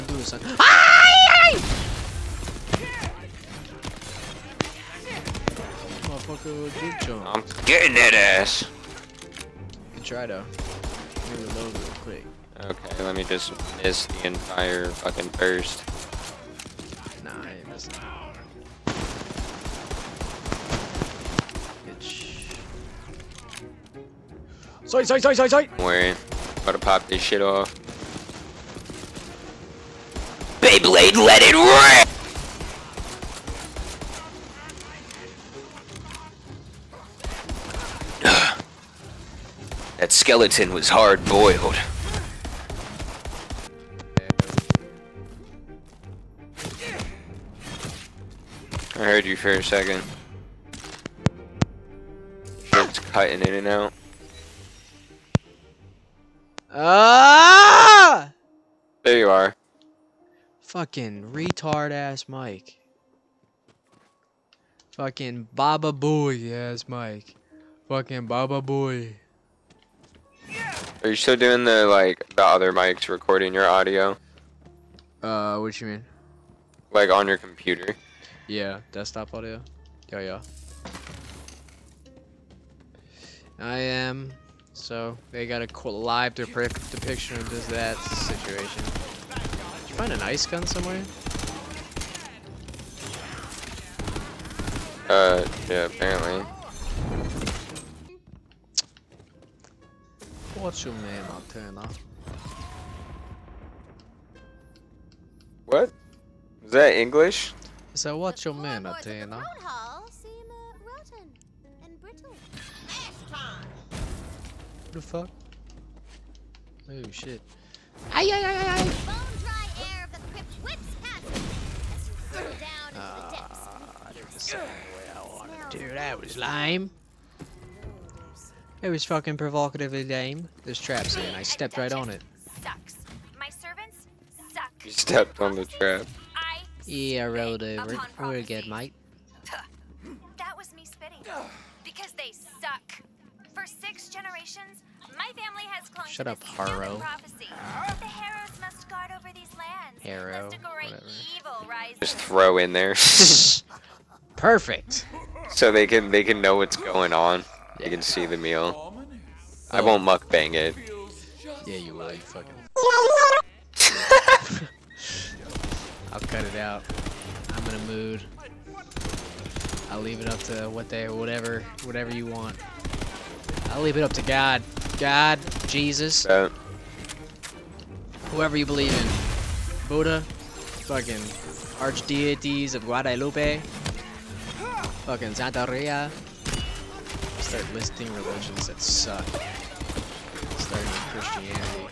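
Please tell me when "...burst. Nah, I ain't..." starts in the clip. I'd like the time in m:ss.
0:15.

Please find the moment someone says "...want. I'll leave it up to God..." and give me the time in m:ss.
2:52.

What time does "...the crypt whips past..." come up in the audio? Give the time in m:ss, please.
2:00.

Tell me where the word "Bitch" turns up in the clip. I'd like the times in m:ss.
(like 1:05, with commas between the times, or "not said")
0:21.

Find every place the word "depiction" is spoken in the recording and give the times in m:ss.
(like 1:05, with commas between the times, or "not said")
1:26.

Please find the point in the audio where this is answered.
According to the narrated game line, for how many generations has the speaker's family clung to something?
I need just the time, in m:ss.
2:23.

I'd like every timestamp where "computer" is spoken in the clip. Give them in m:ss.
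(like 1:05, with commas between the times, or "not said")
1:17.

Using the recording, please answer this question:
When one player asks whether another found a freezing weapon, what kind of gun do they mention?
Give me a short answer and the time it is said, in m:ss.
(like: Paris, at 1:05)
Ice gun, at 1:30.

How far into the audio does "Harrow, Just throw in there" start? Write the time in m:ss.
2:30.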